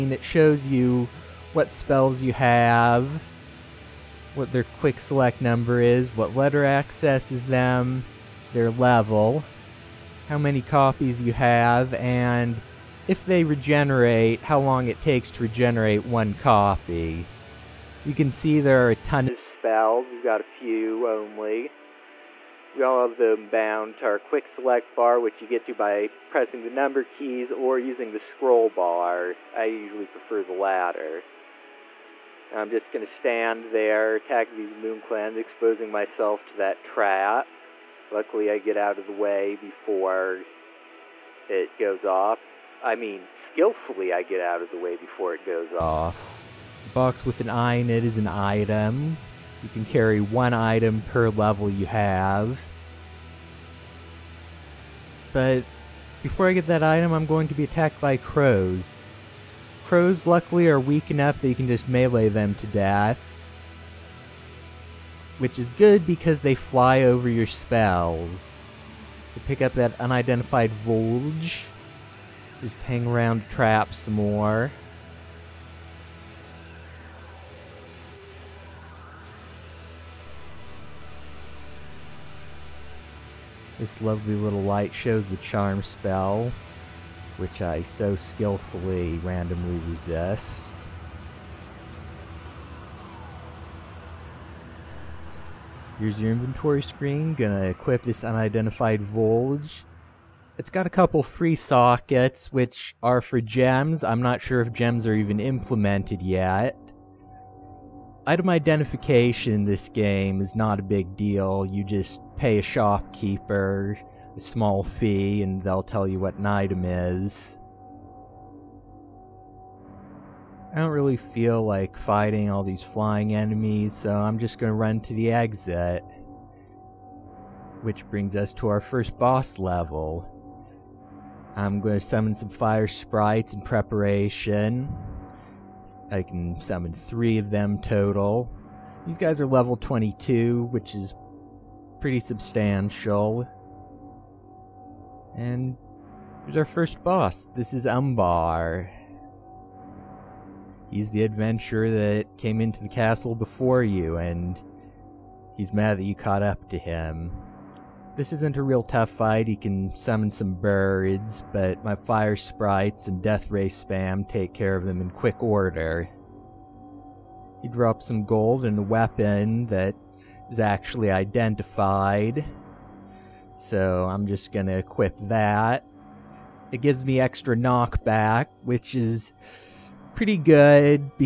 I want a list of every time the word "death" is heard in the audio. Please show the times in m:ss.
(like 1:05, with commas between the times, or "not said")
1:02, 2:43.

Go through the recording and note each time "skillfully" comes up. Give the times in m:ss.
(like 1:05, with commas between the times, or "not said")
0:43, 1:28.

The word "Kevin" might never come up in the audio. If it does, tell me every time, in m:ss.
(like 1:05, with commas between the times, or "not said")
not said.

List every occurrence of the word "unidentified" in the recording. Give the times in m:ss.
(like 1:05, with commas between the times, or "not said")
1:09, 1:38.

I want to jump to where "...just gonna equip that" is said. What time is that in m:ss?
2:54.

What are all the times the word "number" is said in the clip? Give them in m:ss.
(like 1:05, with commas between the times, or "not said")
0:05, 0:26.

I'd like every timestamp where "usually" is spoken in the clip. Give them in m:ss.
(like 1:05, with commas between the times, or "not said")
0:29.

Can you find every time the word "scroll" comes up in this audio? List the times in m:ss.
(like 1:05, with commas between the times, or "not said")
0:28.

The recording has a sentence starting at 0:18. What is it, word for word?
You can see there are a ton of spells.